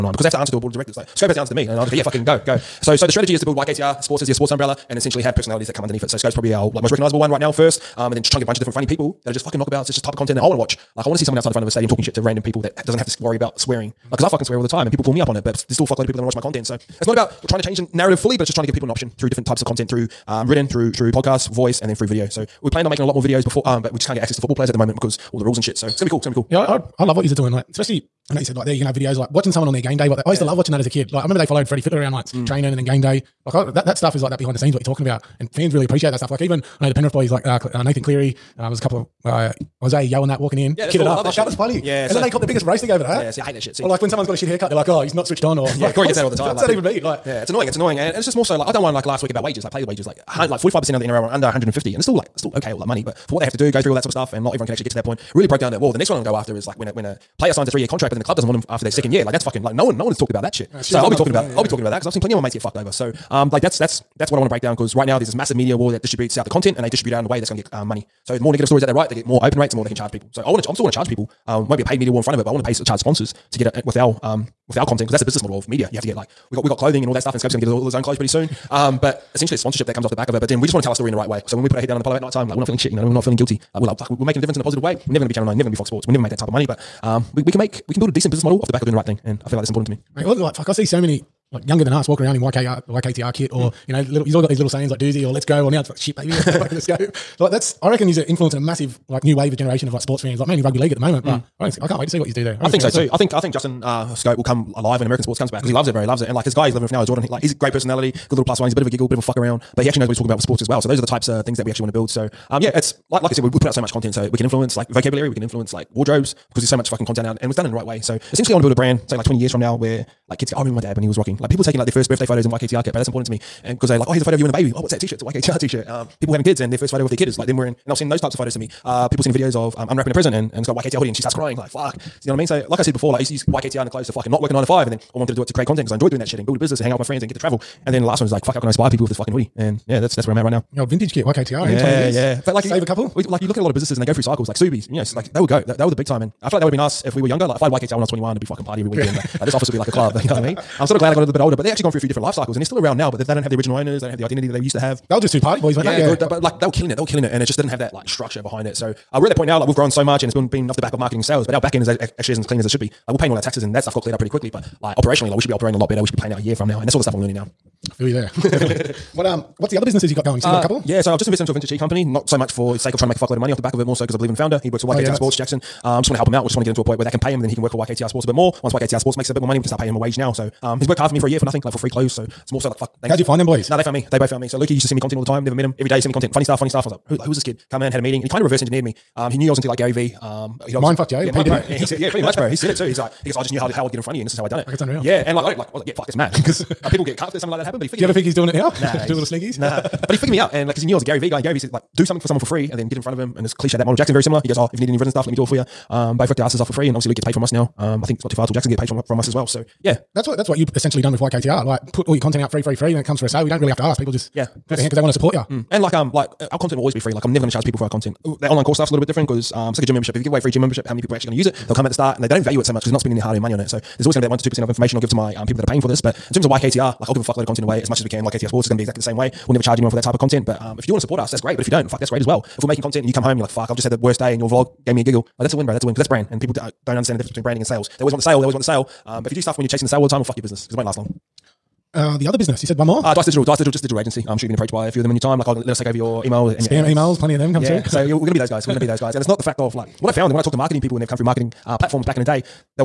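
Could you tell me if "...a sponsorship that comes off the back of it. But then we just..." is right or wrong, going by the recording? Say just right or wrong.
right.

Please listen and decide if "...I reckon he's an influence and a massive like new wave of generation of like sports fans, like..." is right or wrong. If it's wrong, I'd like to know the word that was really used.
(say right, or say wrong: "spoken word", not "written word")
right.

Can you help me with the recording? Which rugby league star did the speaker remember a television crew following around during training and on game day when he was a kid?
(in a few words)
Freddie Fittler.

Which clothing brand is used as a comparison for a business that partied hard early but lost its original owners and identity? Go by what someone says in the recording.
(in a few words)
Subies.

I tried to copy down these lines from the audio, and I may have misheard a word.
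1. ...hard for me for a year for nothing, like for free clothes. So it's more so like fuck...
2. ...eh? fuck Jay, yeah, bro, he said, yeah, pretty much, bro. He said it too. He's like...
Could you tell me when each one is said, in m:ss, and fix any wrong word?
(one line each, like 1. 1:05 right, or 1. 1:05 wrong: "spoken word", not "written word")
1. 3:00 right
2. 3:10 right.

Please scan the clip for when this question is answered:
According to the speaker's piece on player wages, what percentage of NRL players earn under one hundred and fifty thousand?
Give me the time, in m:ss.
0:50.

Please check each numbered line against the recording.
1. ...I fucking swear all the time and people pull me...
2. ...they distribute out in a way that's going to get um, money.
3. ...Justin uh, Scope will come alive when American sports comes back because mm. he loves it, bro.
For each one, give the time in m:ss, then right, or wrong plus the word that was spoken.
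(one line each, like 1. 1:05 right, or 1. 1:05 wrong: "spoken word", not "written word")
1. 0:14 right
2. 1:06 right
3. 1:43 right.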